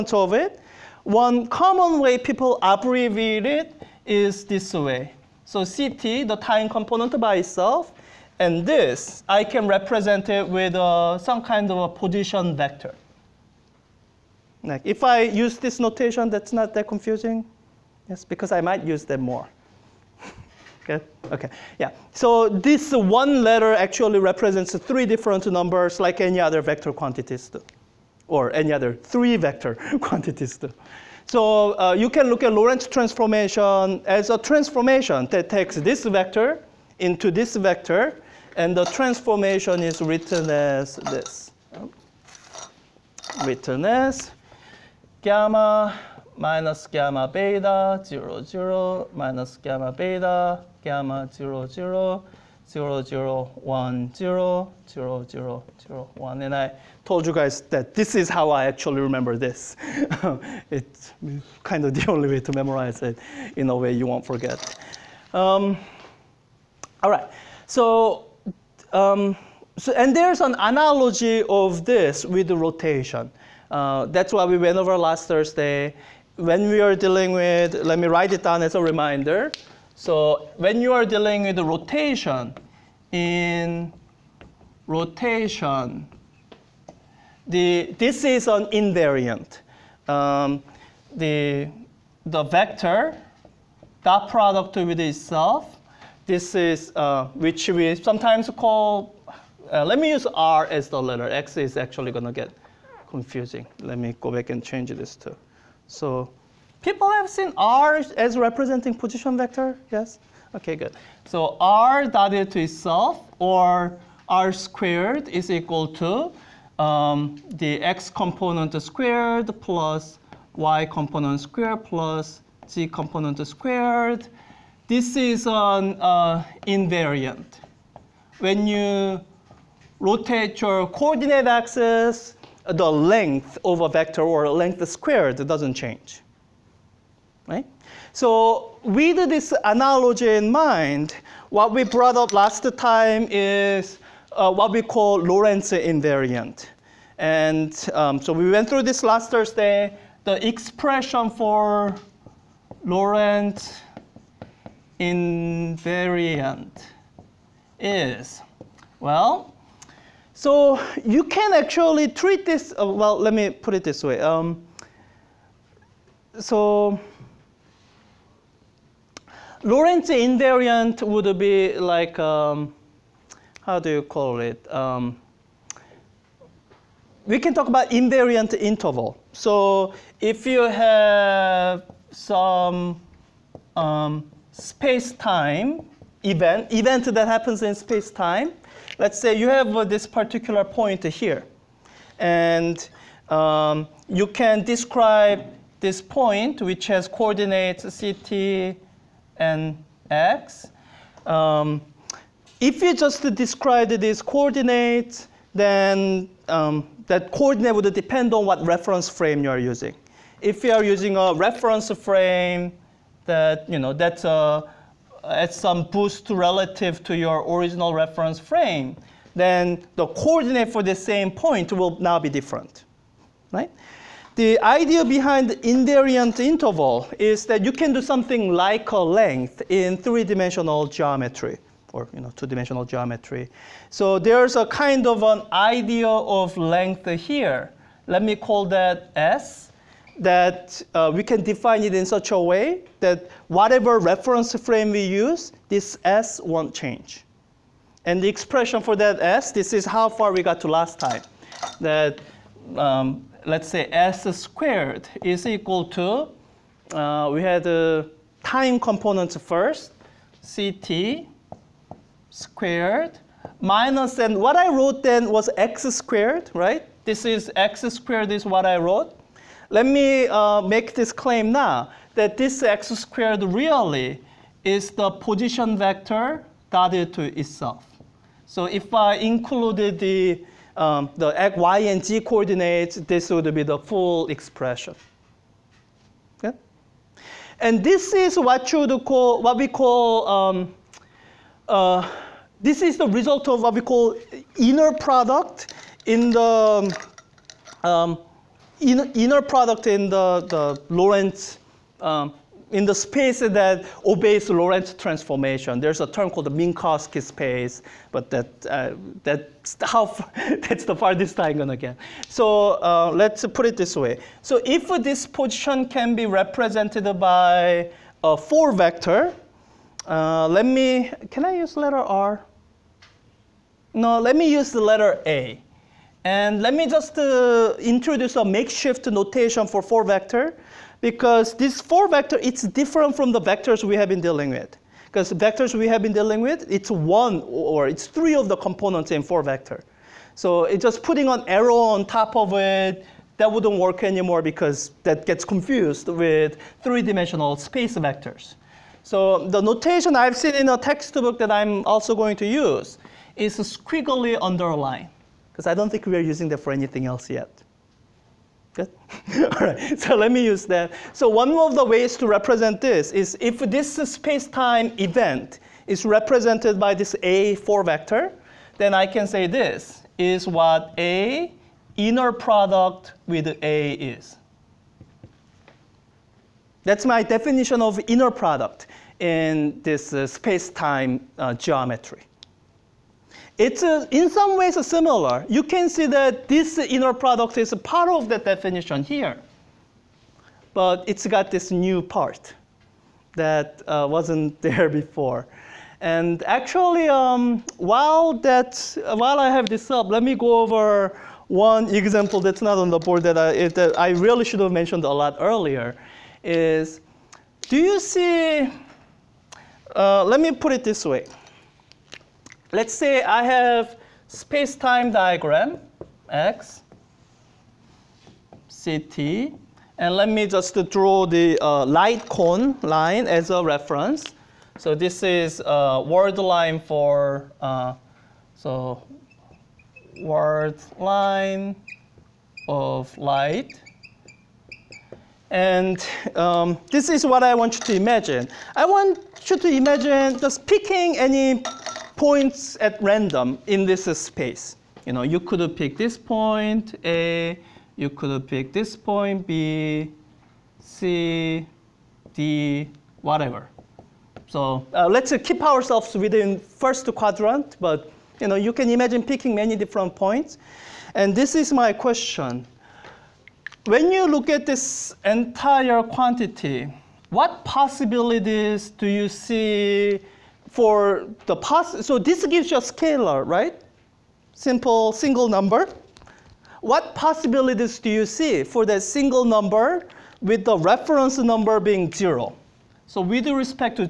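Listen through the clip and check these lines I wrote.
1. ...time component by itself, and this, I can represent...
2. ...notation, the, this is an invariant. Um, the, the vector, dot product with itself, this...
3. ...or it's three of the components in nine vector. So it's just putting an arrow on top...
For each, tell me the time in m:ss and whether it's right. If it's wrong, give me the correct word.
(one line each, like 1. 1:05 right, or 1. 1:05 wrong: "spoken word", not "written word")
1. 0:06 right
2. 1:24 wrong: "rotation", not "notation"
3. 5:37 wrong: "four", not "nine".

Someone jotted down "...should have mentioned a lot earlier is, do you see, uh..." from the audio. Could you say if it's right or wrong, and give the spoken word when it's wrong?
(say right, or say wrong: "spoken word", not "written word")
right.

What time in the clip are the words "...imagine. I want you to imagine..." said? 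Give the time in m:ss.
7:17.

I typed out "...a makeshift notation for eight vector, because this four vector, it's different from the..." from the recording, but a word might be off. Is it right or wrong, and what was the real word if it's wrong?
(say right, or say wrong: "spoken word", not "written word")
wrong: "four", not "eight".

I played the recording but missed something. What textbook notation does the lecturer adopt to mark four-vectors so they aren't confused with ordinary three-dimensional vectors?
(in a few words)
Squiggly underline.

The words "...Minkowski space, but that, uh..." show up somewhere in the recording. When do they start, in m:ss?
5:06.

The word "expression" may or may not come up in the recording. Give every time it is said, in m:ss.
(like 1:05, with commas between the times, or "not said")
2:30, 4:08, 4:44.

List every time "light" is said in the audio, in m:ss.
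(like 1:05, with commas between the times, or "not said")
7:01, 7:13.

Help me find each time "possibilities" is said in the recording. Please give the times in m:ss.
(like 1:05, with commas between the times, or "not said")
7:47, 7:57.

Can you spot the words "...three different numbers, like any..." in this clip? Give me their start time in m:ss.
0:24.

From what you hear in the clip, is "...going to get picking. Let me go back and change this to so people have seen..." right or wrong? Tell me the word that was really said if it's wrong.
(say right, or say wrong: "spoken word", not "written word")
wrong: "confusing", not "picking".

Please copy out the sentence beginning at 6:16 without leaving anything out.
That's my definition of inner product in this uh, space-time uh, geometry.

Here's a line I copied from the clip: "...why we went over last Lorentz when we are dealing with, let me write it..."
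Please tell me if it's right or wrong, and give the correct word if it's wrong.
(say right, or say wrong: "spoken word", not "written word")
wrong: "Thursday", not "Lorentz".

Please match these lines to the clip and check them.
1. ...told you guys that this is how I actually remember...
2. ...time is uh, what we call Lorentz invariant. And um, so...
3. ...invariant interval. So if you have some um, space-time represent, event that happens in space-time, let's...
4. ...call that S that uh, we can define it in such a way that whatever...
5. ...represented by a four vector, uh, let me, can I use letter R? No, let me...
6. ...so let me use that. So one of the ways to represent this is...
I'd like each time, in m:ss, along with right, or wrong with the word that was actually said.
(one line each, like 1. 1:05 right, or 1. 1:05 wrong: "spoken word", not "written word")
1. 0:57 right
2. 2:22 right
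3. 2:57 wrong: "event", not "represent"
4. 3:58 right
5. 5:16 right
6. 5:59 right.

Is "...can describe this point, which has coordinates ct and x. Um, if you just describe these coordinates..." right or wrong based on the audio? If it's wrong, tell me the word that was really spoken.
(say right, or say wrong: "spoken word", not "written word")
right.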